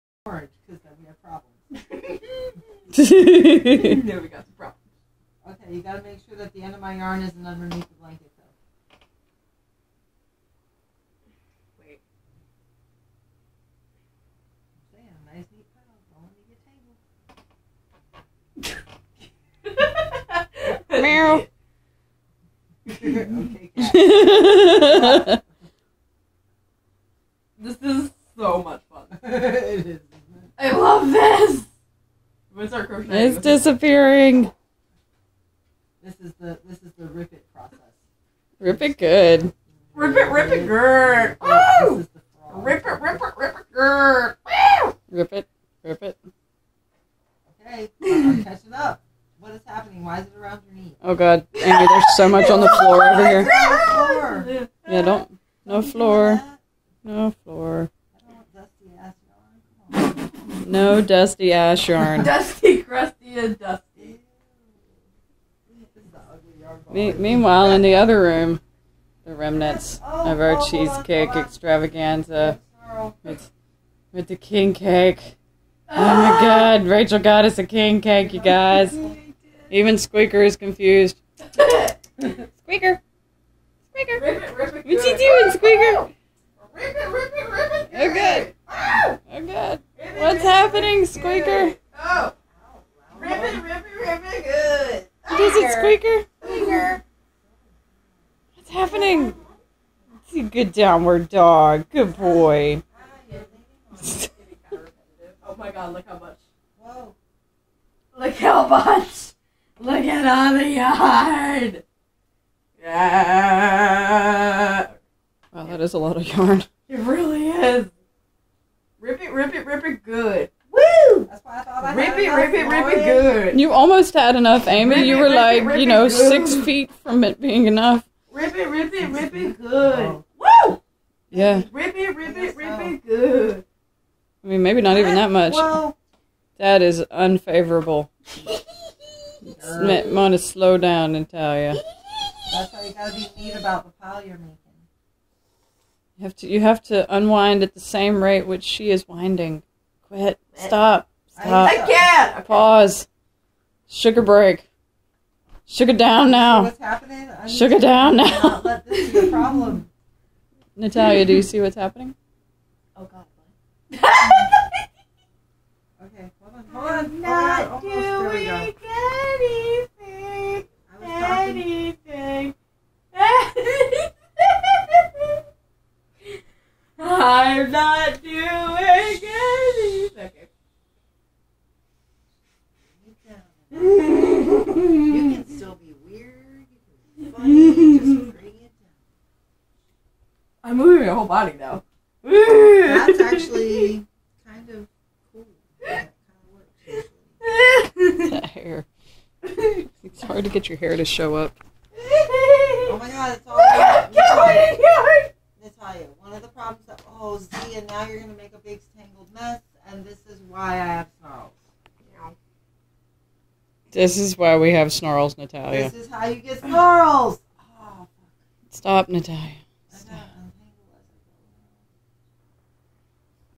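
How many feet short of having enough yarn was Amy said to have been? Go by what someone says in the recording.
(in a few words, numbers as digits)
6.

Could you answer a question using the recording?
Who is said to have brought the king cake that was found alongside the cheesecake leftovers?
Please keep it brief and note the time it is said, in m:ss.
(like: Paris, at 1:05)
Rachael, at 1:16.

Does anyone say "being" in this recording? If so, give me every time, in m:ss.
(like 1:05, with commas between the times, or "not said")
2:07.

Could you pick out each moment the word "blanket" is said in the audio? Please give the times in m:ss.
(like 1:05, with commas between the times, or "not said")
0:07.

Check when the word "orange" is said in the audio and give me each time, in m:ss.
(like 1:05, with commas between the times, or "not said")
0:00.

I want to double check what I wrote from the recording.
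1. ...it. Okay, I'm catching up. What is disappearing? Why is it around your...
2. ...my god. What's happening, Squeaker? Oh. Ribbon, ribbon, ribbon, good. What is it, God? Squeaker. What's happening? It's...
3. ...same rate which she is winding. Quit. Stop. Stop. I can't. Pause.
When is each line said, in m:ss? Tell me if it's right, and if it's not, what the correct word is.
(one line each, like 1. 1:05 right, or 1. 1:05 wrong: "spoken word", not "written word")
1. 0:46 wrong: "happening", not "disappearing"
2. 1:29 wrong: "Squeaker", not "God"
3. 2:27 right.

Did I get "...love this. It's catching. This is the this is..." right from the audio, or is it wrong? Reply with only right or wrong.
wrong.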